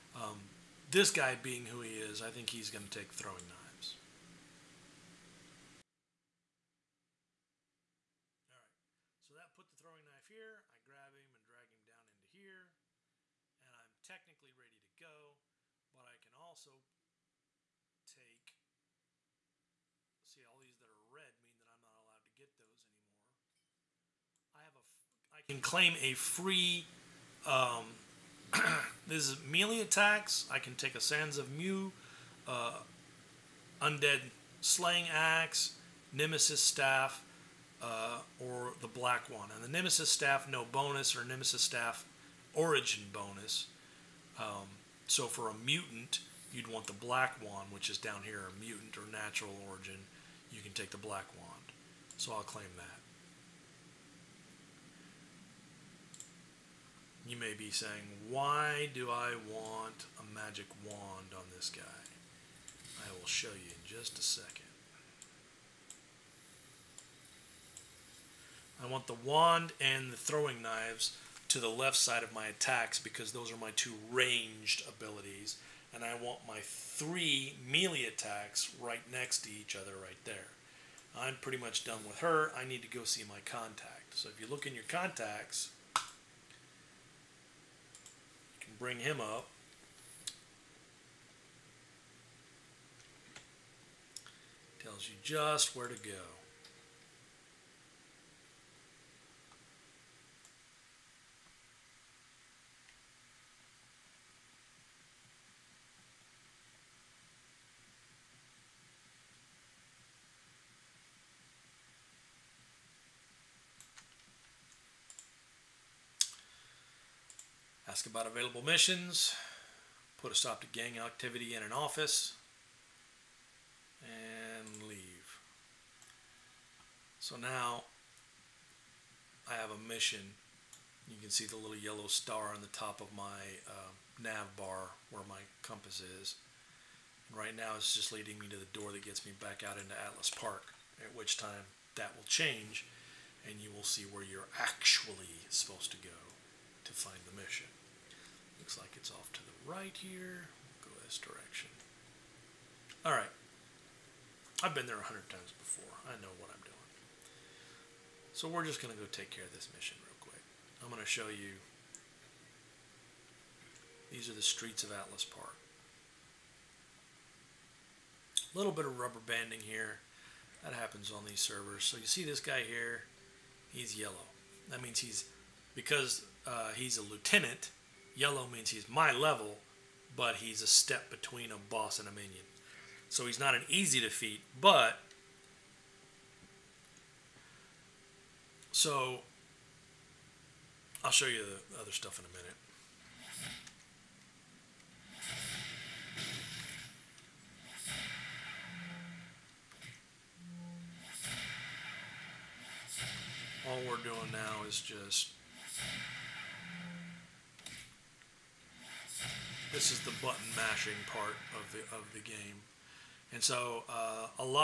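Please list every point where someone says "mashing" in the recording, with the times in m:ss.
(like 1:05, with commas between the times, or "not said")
3:30.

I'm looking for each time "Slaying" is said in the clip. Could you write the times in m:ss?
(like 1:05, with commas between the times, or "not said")
0:34.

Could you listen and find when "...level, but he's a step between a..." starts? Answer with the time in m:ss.
2:59.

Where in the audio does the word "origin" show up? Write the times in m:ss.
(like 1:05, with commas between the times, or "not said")
0:42, 0:49.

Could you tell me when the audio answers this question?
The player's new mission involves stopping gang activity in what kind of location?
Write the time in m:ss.
2:01.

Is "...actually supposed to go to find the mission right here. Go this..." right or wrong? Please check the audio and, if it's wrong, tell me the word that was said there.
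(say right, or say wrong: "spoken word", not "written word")
right.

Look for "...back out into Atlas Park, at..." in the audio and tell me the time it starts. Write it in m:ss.
2:19.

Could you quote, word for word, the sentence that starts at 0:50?
You can take the Black Wand.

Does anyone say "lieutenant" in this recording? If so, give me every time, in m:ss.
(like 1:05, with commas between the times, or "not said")
2:57.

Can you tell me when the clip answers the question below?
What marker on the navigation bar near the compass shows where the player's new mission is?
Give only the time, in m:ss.
2:11.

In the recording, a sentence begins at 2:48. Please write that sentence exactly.
A little bit of rubber banding here.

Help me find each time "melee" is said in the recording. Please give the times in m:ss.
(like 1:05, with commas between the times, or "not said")
0:29, 1:17.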